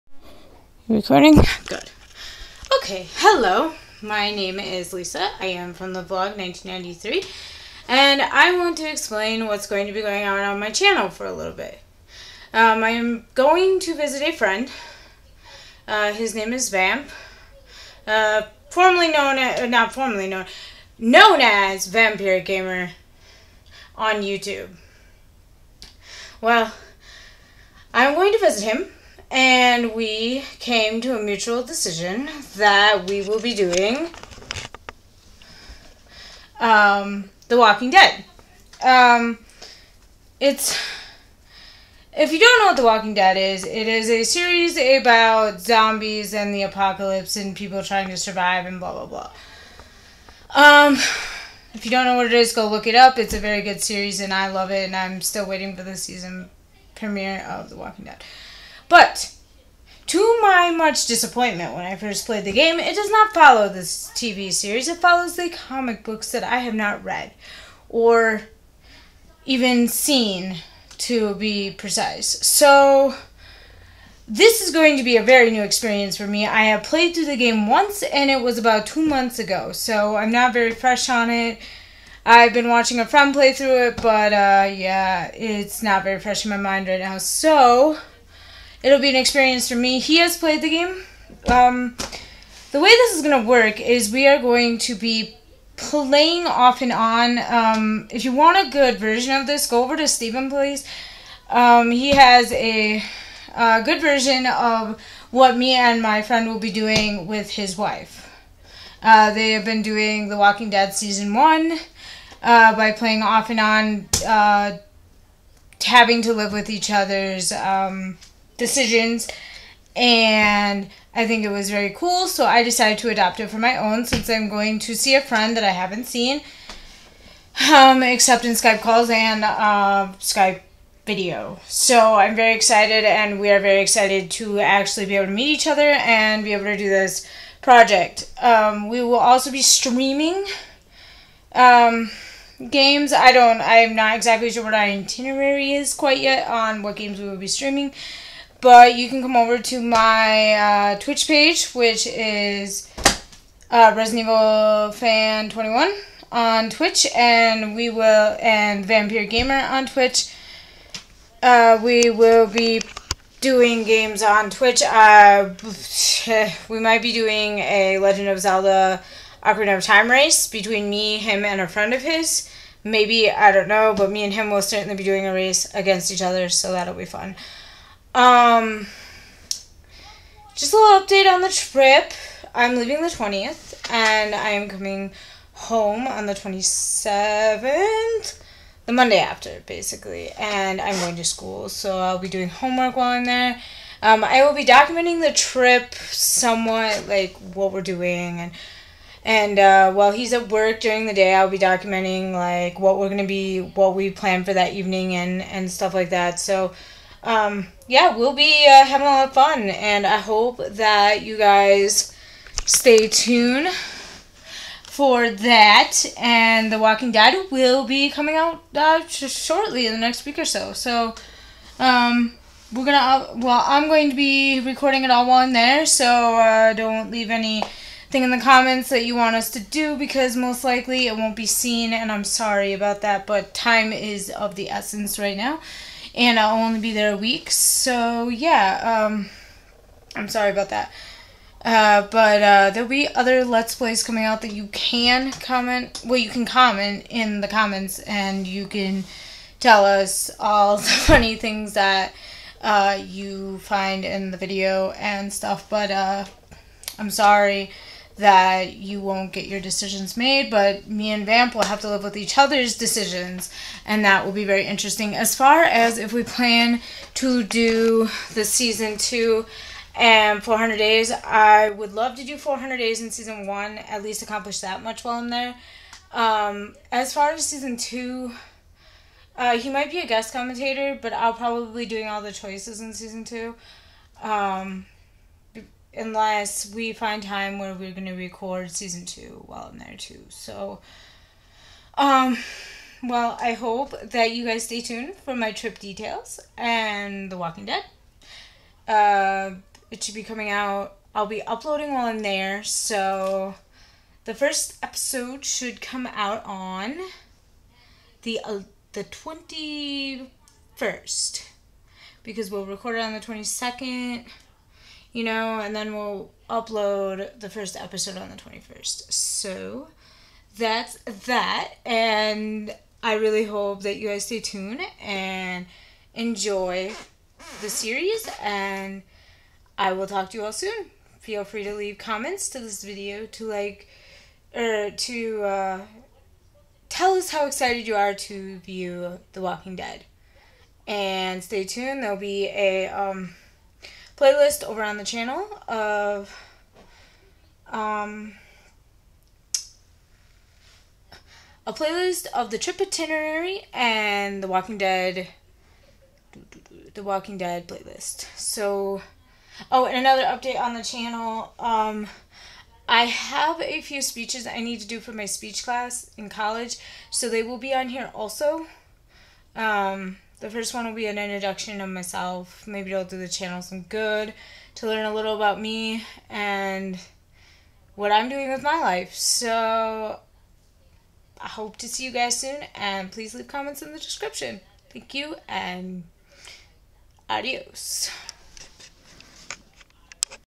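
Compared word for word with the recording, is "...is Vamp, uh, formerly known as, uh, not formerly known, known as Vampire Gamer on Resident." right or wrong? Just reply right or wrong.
wrong.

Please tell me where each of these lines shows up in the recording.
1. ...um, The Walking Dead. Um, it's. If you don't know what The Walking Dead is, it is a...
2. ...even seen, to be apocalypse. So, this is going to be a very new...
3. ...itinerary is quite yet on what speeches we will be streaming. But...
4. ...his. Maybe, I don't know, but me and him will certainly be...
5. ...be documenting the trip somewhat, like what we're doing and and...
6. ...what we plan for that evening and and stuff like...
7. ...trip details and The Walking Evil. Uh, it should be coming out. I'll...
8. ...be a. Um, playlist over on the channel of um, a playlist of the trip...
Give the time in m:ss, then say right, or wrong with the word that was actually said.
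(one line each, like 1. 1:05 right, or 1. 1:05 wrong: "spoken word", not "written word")
1. 0:36 right
2. 1:09 wrong: "precise", not "apocalypse"
3. 2:24 wrong: "games", not "speeches"
4. 2:52 right
5. 3:14 right
6. 3:23 right
7. 4:55 wrong: "Dead", not "Evil"
8. 5:42 right.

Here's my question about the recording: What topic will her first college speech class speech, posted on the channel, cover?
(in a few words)
Introduction of myself.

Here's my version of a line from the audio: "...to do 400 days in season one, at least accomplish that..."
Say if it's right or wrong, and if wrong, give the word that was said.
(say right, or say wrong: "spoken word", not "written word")
right.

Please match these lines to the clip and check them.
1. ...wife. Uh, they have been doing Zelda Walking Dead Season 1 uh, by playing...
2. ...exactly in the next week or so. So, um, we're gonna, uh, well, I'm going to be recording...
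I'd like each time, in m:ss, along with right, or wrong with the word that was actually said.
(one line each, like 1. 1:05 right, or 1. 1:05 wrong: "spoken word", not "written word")
1. 1:47 wrong: "The", not "Zelda"
2. 3:39 wrong: "shortly", not "exactly".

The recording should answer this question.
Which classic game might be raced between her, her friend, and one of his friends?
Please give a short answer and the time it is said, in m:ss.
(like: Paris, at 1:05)
Legend of Zelda Ocarina of Time, at 2:47.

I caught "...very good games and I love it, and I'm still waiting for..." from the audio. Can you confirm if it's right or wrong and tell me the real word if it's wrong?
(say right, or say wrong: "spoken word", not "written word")
wrong: "series", not "games".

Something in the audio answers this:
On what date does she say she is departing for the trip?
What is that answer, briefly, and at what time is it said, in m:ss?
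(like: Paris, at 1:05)
20th, at 3:03.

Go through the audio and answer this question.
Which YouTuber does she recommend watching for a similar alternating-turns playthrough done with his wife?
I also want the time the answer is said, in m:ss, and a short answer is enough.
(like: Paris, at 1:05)
Stephen Plays, at 1:40.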